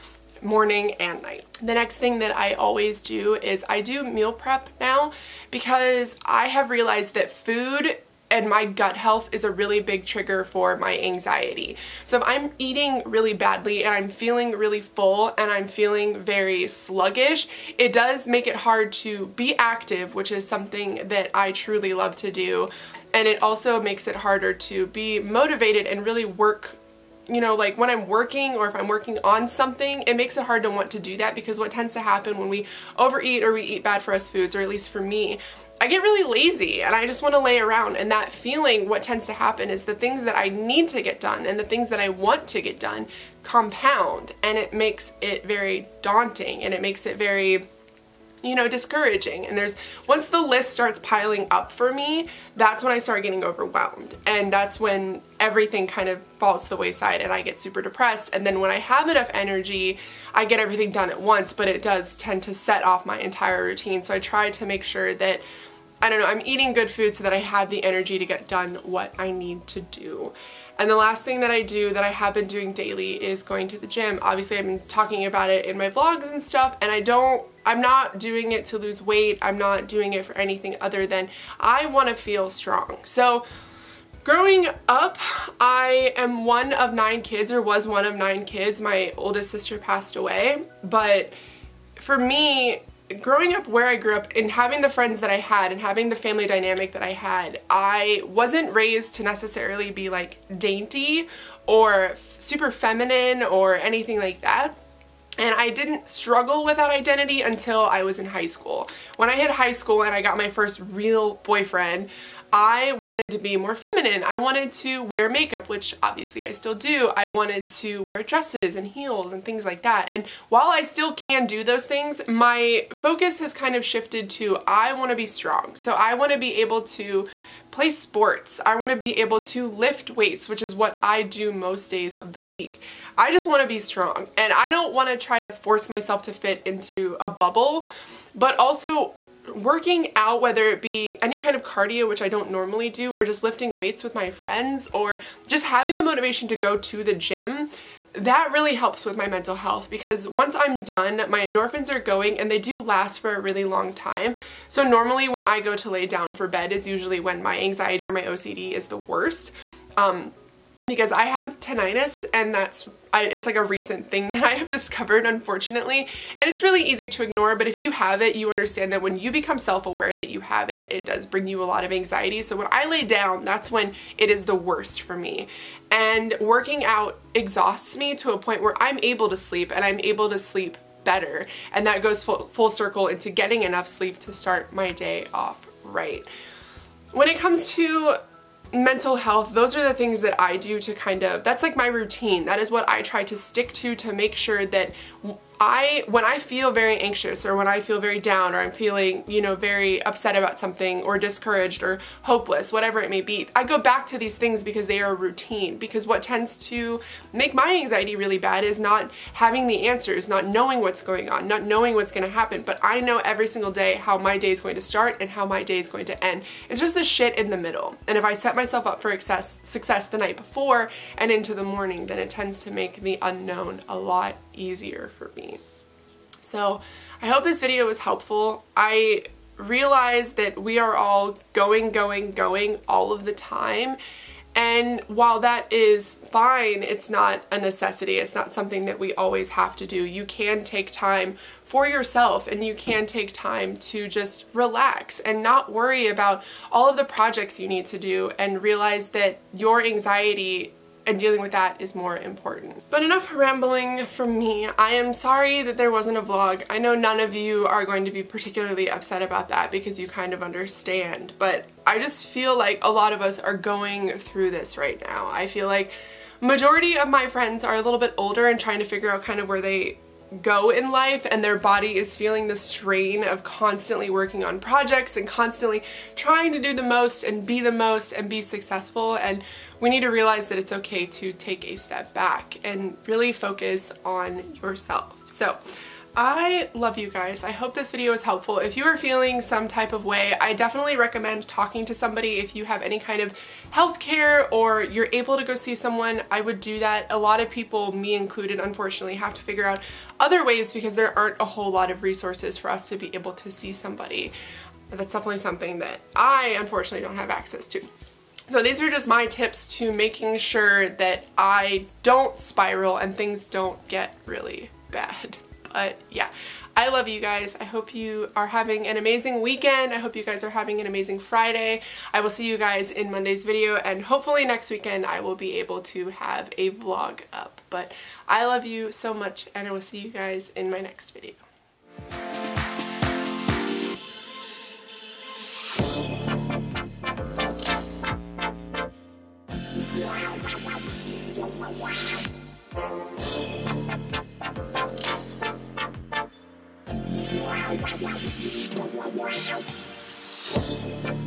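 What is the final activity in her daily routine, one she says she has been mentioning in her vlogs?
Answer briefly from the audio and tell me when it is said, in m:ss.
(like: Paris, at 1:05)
going to the gym, at 1:13.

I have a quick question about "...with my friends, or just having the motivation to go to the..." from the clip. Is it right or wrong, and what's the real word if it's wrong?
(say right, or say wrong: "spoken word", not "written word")
right.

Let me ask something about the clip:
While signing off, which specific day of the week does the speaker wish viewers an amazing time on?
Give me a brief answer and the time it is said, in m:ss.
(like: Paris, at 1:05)
Friday, at 5:21.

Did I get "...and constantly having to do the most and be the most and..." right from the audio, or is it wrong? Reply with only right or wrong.
wrong.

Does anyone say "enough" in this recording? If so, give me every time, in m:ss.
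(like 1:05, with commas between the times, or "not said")
0:59, 3:03, 4:13.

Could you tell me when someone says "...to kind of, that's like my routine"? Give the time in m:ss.
3:10.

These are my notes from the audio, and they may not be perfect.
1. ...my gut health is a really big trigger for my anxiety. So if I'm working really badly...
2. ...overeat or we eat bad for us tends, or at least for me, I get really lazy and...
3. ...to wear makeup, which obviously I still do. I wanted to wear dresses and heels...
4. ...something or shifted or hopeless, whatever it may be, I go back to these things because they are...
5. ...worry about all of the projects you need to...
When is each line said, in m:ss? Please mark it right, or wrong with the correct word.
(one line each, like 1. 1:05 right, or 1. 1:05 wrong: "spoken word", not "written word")
1. 0:08 wrong: "eating", not "working"
2. 0:32 wrong: "foods", not "tends"
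3. 1:54 right
4. 3:20 wrong: "discouraged", not "shifted"
5. 4:05 right.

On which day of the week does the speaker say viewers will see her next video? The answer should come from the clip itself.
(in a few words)
Monday.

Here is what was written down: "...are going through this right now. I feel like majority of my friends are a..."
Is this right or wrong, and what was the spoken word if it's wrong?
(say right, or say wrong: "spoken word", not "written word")
right.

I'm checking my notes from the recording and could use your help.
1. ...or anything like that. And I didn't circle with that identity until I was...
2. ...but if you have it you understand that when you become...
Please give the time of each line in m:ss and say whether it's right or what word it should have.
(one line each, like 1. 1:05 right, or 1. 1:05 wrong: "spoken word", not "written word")
1. 1:43 wrong: "struggle", not "circle"
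2. 2:47 right.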